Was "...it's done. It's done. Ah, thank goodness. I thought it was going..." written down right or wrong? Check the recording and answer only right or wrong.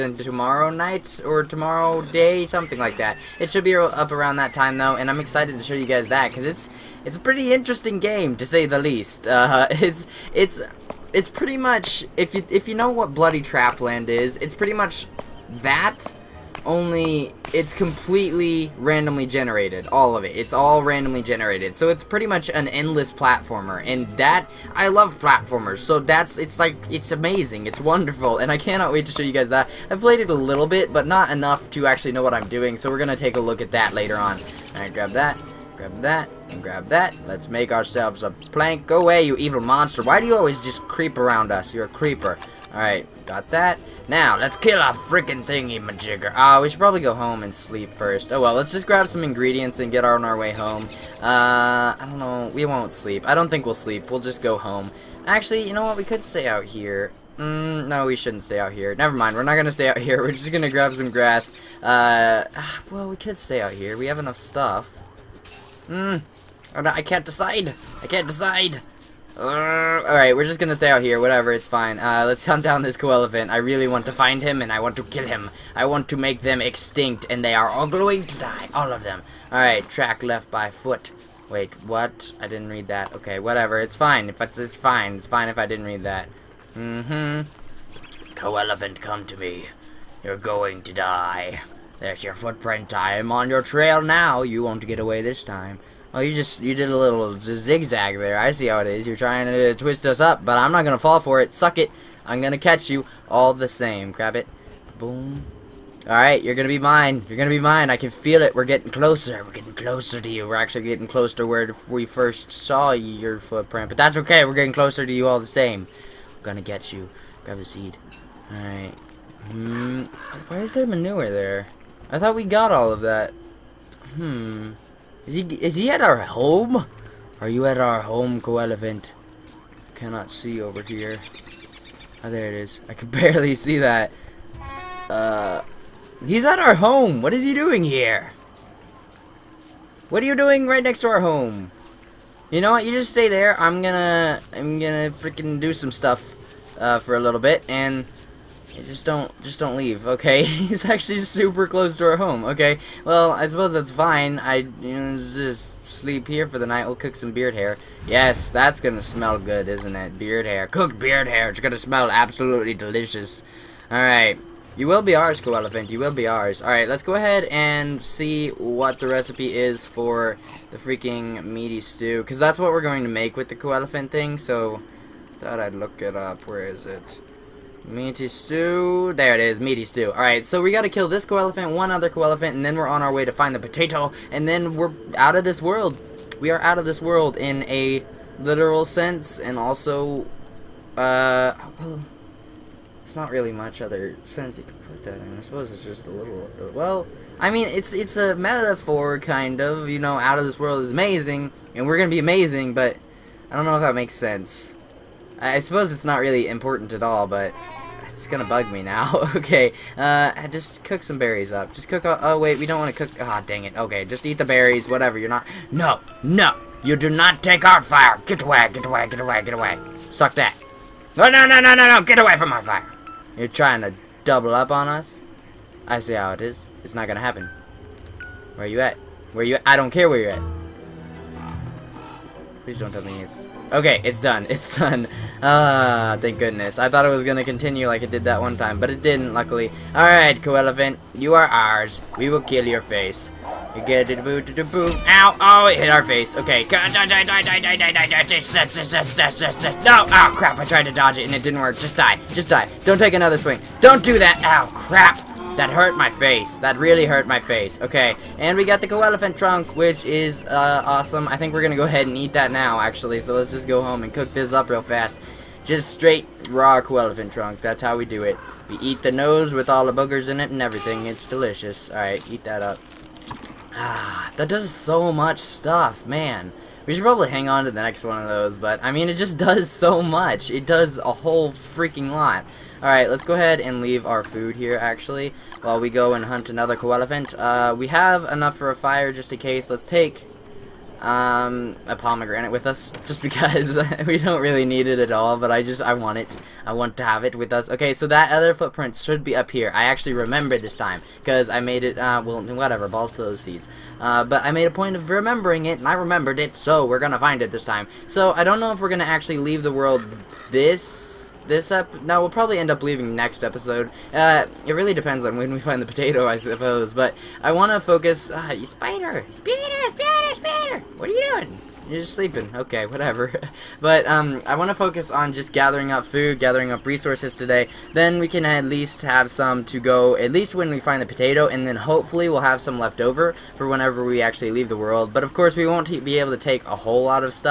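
right.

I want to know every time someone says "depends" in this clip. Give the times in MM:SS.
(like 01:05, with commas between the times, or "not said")
05:14.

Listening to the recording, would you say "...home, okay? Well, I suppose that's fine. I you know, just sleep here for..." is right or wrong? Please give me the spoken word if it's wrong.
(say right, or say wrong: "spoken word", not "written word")
right.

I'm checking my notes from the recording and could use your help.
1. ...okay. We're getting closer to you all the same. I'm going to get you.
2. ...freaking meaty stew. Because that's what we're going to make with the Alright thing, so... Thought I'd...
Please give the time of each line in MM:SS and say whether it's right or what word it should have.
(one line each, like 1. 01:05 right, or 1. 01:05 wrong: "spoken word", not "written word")
1. 01:54 right
2. 02:50 wrong: "Koalefant", not "Alright".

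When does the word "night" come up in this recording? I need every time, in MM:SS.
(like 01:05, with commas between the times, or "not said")
00:00, 02:36.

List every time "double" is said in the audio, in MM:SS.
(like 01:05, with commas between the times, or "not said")
03:44.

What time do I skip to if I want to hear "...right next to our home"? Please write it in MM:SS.
02:20.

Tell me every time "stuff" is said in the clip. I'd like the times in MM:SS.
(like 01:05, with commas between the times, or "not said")
01:04, 02:25, 04:35.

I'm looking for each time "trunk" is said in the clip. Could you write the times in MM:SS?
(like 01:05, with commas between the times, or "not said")
04:19, 04:27.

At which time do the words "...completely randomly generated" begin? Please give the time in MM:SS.
00:17.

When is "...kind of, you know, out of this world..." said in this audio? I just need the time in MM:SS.
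03:19.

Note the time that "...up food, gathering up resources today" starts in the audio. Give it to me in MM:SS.
05:25.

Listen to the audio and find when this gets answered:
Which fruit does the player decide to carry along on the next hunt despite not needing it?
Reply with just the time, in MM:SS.
04:51.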